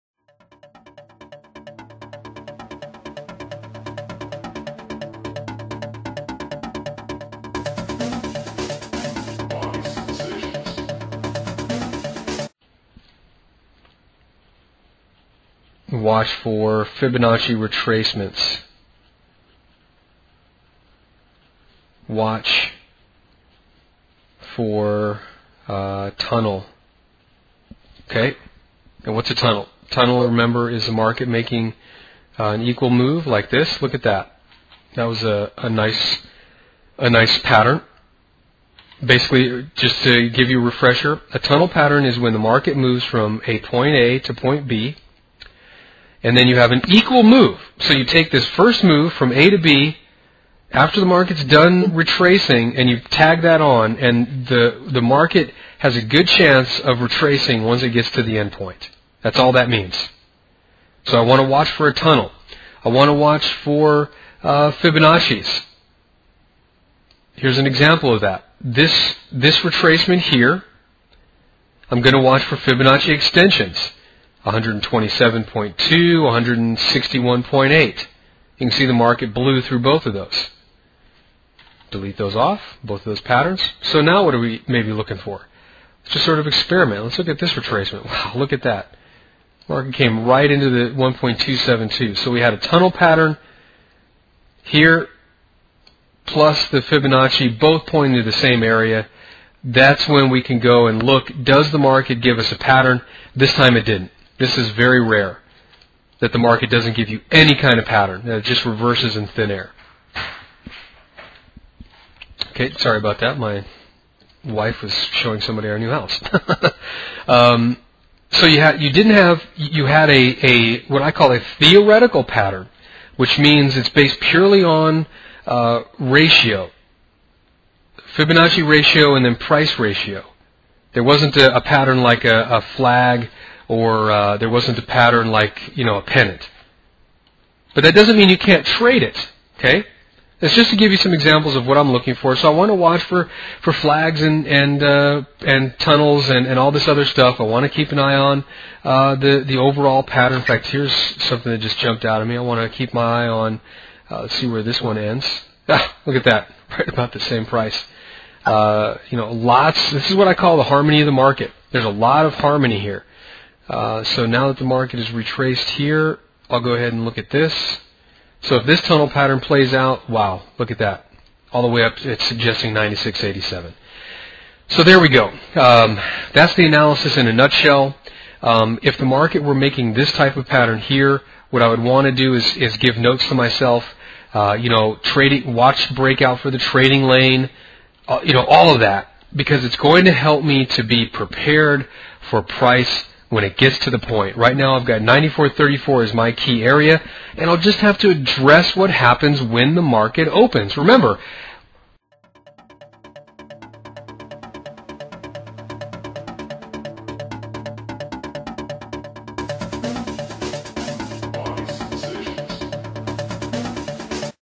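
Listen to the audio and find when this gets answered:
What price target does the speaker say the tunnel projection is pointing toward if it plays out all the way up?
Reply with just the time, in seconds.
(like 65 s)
172 s.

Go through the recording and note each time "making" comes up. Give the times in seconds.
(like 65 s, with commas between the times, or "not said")
31 s, 179 s.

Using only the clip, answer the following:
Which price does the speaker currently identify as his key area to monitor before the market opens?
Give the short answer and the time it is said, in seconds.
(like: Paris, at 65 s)
94.34, at 195 s.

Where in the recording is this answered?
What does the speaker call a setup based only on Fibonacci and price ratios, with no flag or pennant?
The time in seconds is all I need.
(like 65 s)
121 s.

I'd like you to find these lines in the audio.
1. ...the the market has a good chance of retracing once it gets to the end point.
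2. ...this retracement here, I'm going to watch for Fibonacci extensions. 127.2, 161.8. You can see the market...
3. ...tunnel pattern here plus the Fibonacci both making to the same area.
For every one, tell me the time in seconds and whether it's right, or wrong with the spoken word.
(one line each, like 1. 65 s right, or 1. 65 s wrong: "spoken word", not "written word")
1. 54 s right
2. 69 s right
3. 92 s wrong: "pointing", not "making".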